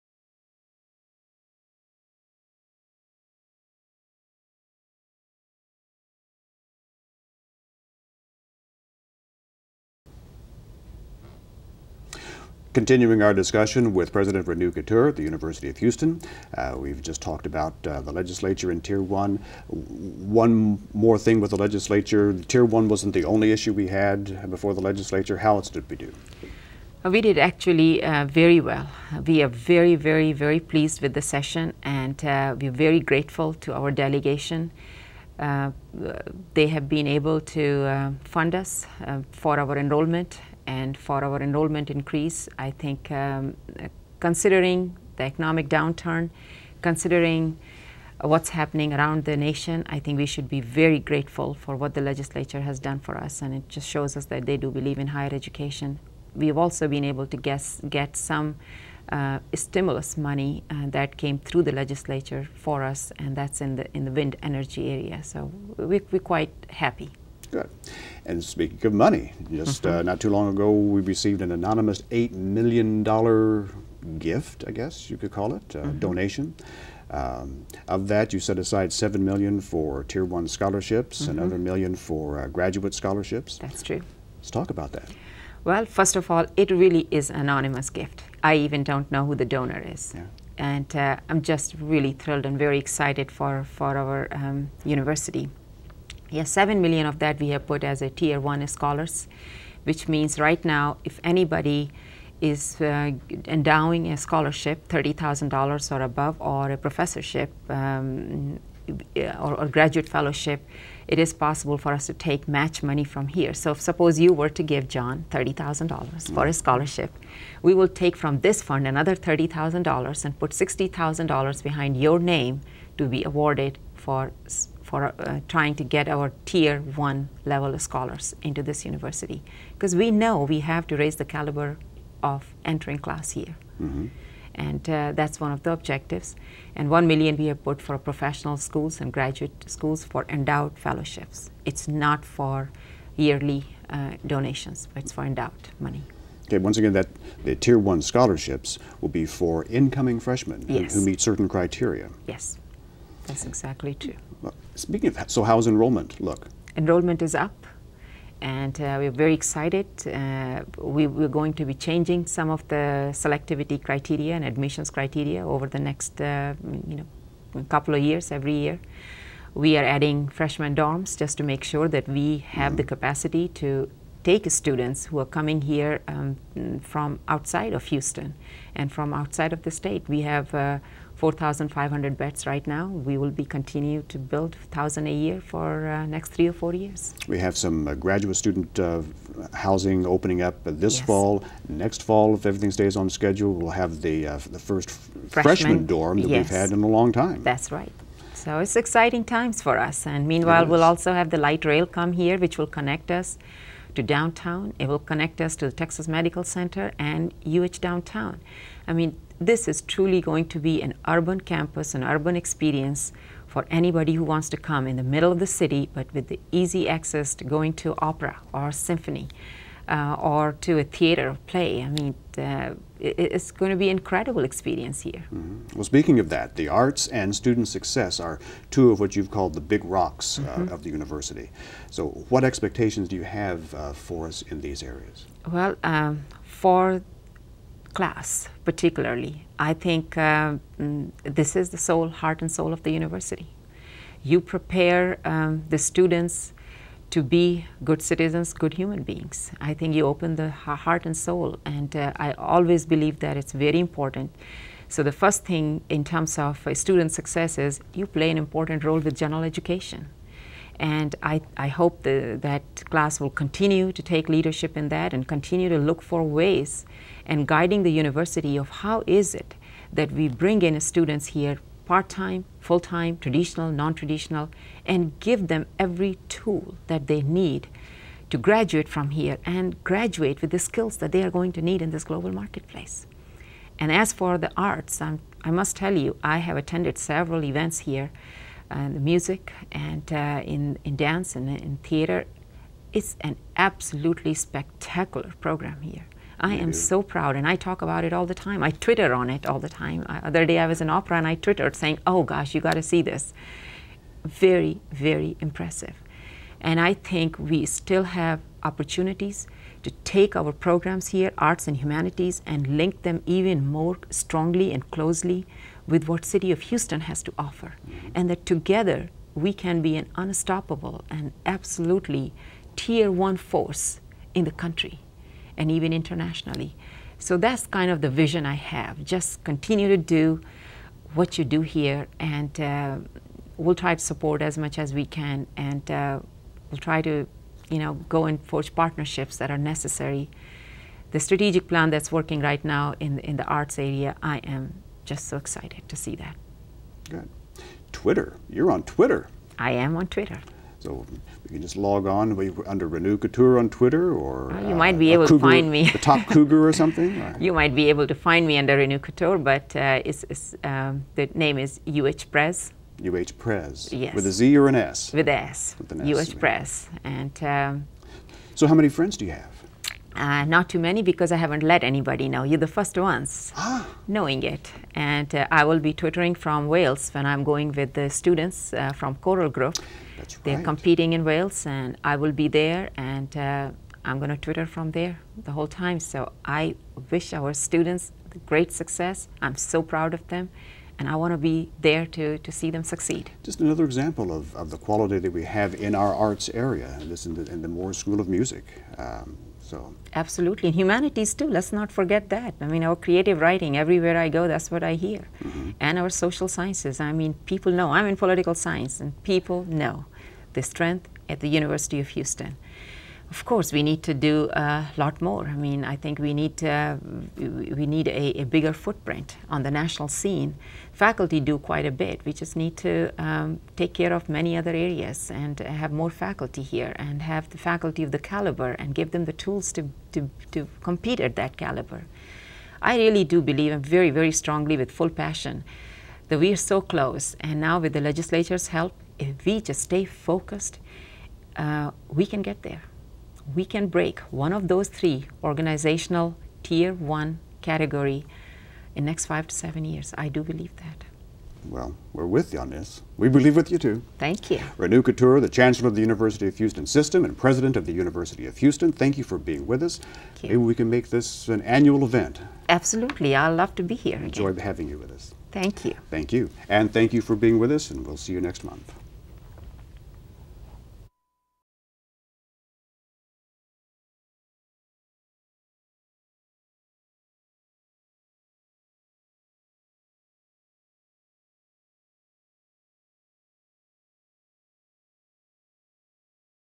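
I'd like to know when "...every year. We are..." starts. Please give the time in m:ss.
2:48.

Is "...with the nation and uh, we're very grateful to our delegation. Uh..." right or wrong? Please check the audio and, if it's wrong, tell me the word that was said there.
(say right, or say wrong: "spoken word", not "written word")
wrong: "session", not "nation".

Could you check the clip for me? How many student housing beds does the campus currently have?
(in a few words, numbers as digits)
4,500.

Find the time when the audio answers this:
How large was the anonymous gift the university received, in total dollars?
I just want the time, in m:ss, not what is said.
1:12.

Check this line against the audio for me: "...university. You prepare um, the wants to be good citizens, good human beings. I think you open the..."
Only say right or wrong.
wrong.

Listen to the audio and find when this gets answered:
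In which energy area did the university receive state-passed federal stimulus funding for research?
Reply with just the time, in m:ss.
1:04.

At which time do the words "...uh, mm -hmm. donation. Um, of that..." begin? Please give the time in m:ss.
1:15.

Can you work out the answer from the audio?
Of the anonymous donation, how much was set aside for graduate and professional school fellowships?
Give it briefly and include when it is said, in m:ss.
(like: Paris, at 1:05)
1 million, at 2:16.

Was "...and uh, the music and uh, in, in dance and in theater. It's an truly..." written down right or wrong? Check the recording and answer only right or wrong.
wrong.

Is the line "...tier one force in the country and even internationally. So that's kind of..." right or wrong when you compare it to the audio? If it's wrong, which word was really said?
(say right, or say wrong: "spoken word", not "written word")
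right.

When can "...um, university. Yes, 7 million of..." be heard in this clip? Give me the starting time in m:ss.
1:34.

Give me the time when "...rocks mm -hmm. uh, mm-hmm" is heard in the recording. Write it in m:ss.
3:49.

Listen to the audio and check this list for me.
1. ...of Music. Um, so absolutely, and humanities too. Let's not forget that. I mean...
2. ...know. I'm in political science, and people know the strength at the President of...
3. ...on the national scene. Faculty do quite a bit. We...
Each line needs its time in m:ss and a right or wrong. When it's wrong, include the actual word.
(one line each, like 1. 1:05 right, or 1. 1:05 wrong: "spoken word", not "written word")
1. 6:38 right
2. 6:47 wrong: "University", not "President"
3. 6:59 right.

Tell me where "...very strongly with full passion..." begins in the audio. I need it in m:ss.
7:14.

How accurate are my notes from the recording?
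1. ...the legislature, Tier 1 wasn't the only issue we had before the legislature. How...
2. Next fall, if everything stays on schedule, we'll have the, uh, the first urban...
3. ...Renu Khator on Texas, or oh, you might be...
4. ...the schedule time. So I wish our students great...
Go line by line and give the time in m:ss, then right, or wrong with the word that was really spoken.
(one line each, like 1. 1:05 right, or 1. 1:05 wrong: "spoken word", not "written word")
1. 0:21 right
2. 3:11 wrong: "freshman", not "urban"
3. 5:52 wrong: "Twitter", not "Texas"
4. 6:25 wrong: "whole", not "schedule".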